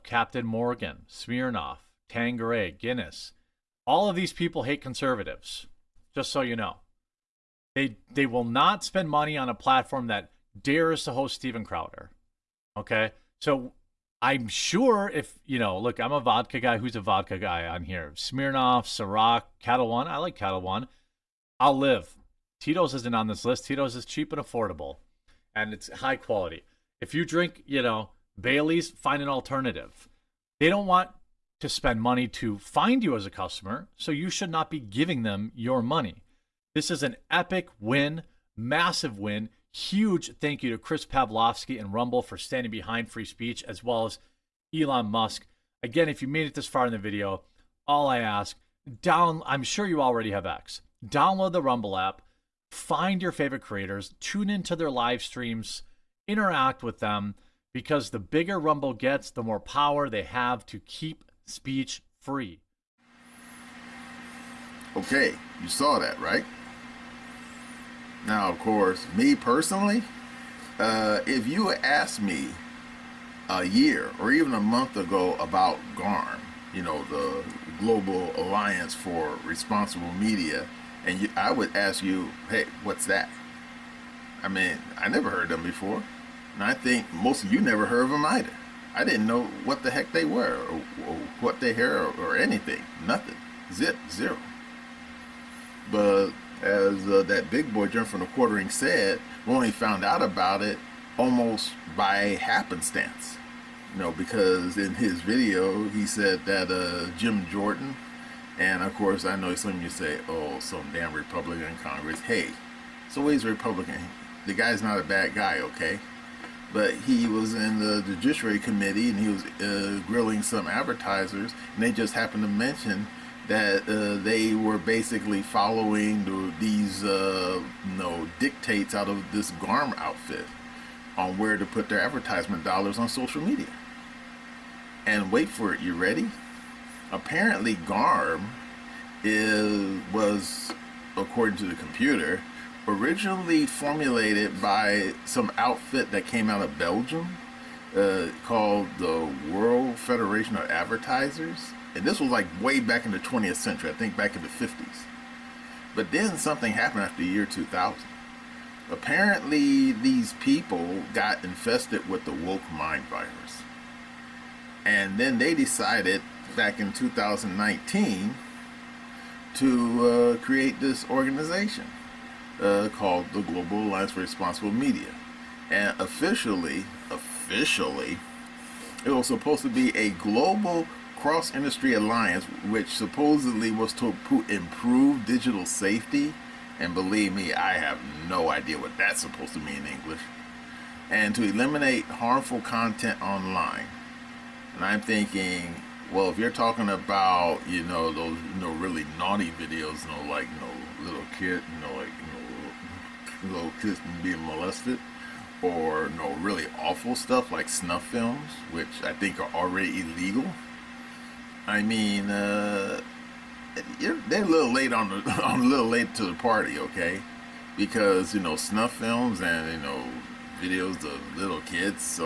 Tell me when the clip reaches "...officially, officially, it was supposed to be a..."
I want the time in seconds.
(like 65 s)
175 s.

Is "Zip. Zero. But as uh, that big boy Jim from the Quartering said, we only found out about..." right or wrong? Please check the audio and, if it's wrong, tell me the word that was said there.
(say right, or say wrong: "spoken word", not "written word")
right.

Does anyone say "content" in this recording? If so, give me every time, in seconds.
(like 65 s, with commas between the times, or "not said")
192 s.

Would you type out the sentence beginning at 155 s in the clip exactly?
But then something happened after the year 2000.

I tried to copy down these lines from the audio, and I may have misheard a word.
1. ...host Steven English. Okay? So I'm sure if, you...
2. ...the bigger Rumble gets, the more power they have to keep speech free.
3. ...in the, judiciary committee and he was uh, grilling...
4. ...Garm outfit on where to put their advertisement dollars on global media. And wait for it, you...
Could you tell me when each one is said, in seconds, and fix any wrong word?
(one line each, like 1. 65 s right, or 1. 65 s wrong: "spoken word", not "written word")
1. 11 s wrong: "Crowder", not "English"
2. 58 s right
3. 117 s right
4. 129 s wrong: "social", not "global".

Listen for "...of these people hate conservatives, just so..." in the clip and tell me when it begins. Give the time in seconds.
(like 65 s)
4 s.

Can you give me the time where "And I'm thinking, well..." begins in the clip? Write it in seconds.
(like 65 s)
194 s.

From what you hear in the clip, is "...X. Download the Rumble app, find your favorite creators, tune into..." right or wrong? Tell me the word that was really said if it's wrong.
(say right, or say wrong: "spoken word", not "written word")
right.